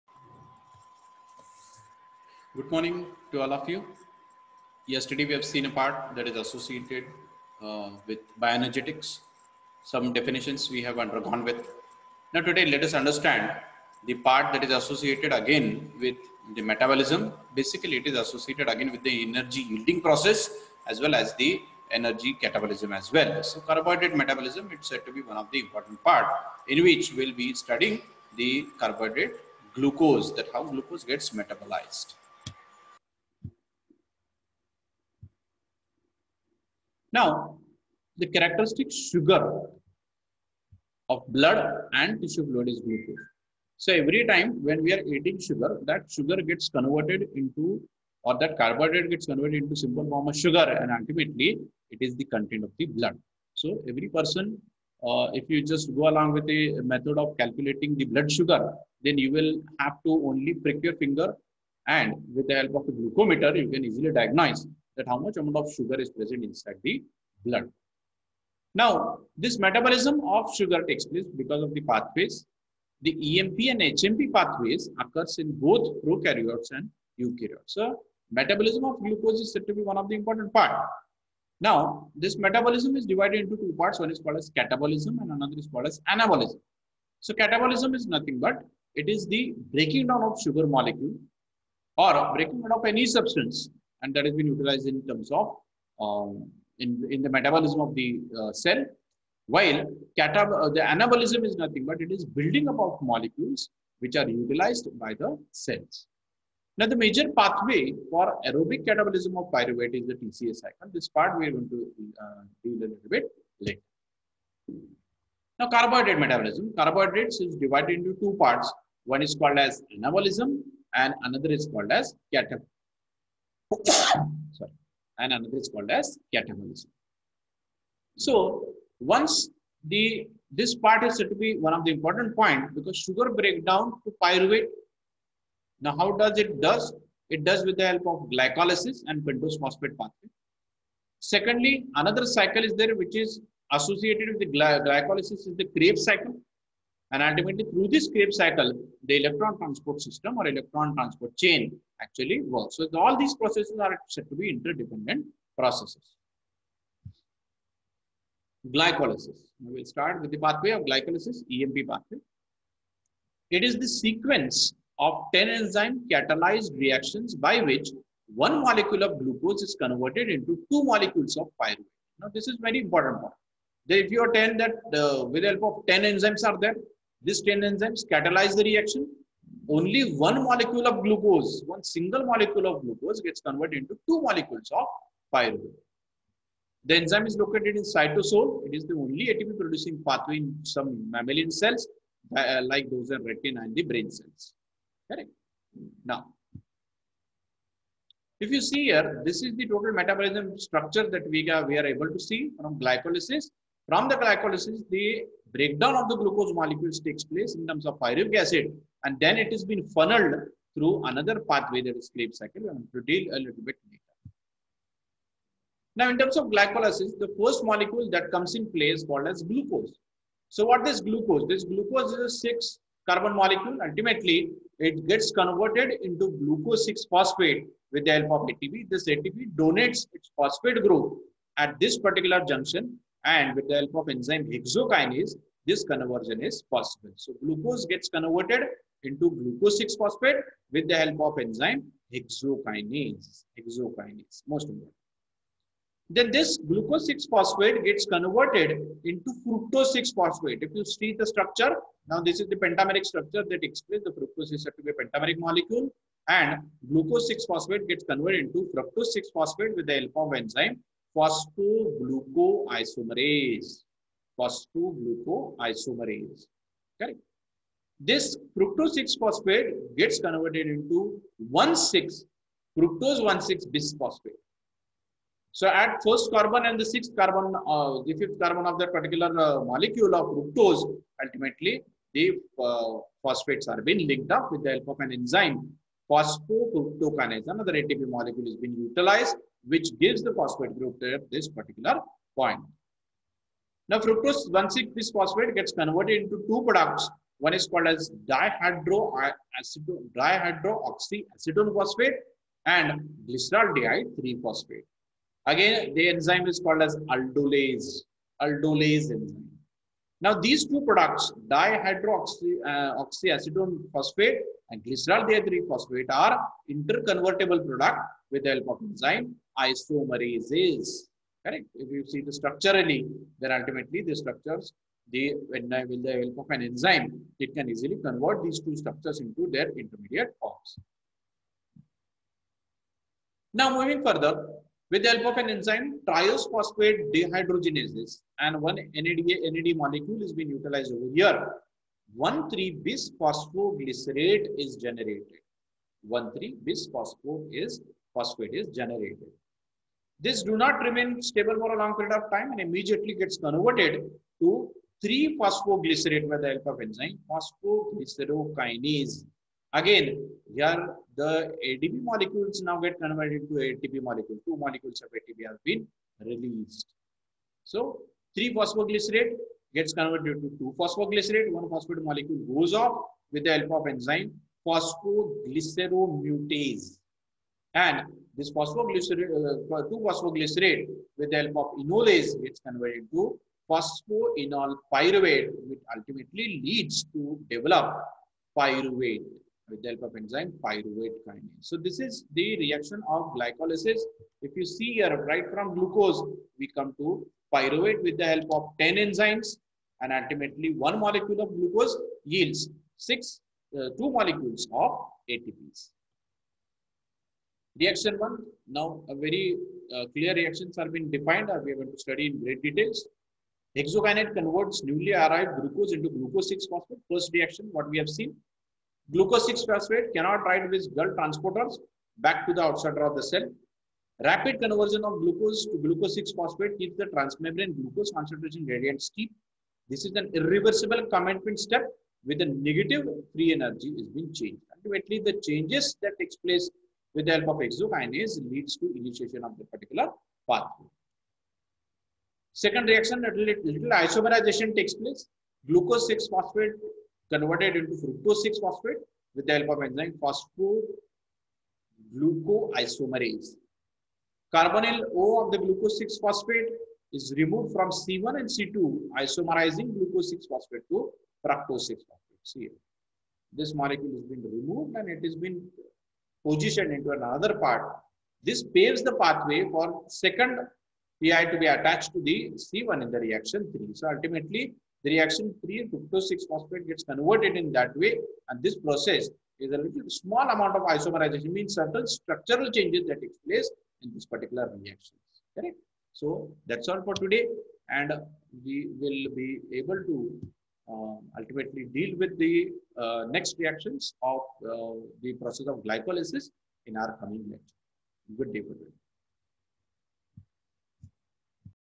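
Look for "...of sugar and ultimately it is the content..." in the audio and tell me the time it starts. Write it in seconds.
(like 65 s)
50 s.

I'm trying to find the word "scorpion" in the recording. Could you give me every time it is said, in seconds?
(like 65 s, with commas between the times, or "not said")
not said.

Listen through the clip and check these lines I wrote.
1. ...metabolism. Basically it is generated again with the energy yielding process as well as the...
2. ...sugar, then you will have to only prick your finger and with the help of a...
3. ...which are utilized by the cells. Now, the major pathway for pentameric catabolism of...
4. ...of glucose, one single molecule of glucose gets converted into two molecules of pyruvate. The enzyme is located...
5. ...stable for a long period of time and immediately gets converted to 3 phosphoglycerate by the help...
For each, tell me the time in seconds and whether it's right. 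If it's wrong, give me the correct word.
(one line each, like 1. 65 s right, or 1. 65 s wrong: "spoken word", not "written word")
1. 16 s wrong: "associated", not "generated"
2. 58 s right
3. 103 s wrong: "aerobic", not "pentameric"
4. 180 s right
5. 351 s right.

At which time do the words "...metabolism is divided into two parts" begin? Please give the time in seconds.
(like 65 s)
82 s.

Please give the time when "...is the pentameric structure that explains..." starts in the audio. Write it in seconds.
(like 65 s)
252 s.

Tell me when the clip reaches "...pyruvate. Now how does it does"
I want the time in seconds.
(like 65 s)
134 s.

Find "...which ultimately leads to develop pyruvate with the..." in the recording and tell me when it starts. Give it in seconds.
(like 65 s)
385 s.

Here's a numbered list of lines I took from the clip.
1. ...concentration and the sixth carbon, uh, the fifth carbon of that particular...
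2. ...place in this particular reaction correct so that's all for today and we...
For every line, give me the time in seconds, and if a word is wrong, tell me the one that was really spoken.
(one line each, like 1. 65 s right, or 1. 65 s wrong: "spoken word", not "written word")
1. 276 s wrong: "carbon", not "concentration"
2. 483 s right.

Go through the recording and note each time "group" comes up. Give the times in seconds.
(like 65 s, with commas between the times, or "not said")
230 s, 290 s.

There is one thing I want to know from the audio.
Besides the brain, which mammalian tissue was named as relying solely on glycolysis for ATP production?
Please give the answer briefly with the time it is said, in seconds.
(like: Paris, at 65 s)
retina, at 193 s.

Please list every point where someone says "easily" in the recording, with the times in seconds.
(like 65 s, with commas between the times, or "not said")
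63 s, 327 s.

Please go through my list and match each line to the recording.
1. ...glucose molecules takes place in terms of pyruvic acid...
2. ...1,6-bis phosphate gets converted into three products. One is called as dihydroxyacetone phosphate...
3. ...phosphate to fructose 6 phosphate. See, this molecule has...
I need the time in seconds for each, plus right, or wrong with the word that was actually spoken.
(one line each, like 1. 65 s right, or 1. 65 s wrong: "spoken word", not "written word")
1. 206 s right
2. 294 s wrong: "two", not "three"
3. 460 s right.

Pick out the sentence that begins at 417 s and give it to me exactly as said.
First reaction, what we have seen.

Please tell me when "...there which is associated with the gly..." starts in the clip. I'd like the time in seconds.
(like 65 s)
142 s.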